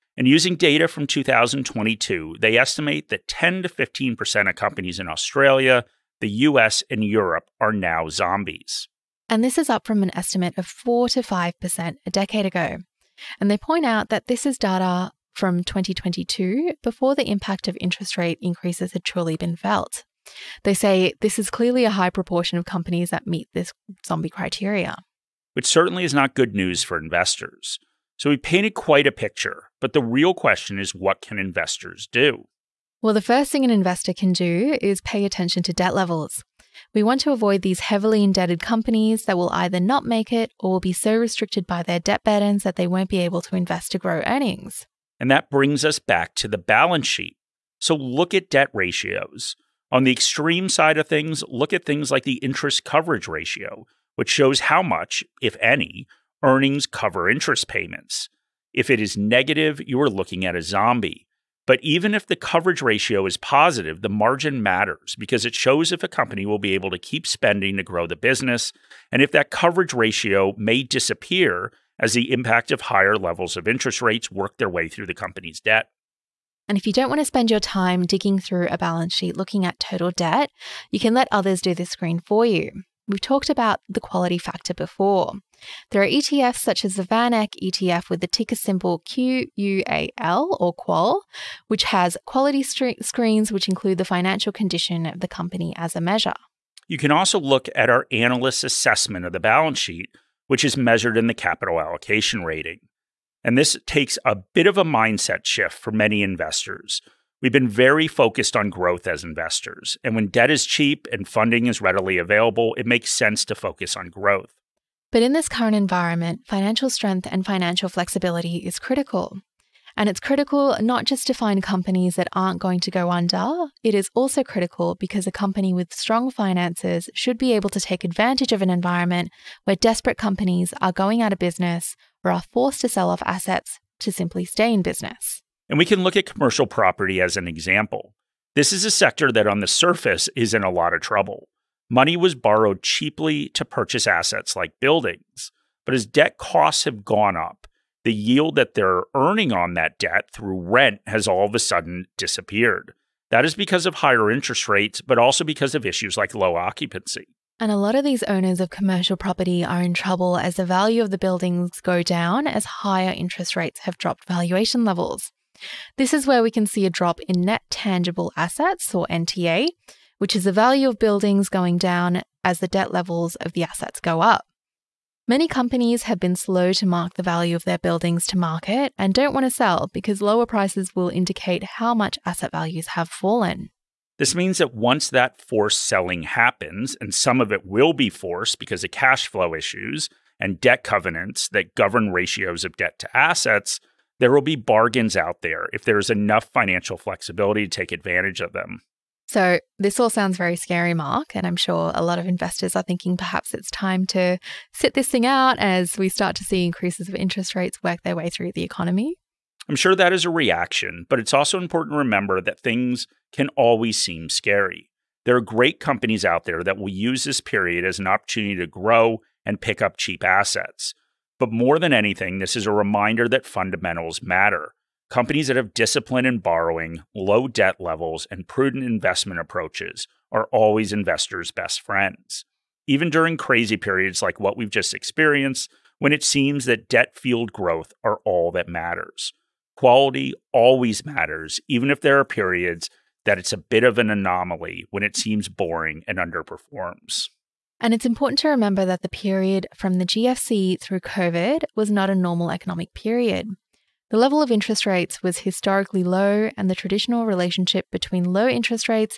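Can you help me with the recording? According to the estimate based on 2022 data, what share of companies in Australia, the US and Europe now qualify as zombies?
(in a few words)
10 to 15%.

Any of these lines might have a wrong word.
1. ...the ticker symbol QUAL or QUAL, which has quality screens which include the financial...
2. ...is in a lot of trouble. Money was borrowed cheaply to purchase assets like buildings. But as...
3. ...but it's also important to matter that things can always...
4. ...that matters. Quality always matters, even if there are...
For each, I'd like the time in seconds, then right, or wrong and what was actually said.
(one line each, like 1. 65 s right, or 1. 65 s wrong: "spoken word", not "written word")
1. 88 s right
2. 140 s right
3. 211 s wrong: "remember", not "matter"
4. 238 s right.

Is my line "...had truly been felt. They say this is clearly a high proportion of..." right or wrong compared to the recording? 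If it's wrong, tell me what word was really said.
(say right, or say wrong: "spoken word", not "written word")
right.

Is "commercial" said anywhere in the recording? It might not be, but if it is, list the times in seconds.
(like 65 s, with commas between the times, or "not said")
136 s, 158 s.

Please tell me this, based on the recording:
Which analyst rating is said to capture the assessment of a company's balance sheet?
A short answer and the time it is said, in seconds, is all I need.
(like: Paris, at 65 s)
capital allocation rating, at 101 s.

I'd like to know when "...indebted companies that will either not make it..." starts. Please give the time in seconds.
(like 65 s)
38 s.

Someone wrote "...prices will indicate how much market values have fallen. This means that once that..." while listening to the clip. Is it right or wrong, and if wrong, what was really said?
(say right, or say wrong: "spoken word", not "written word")
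wrong: "asset", not "market".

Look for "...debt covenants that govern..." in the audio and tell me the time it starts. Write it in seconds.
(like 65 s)
190 s.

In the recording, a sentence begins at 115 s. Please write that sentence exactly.
But in this current environment, financial strength and financial flexibility is critical.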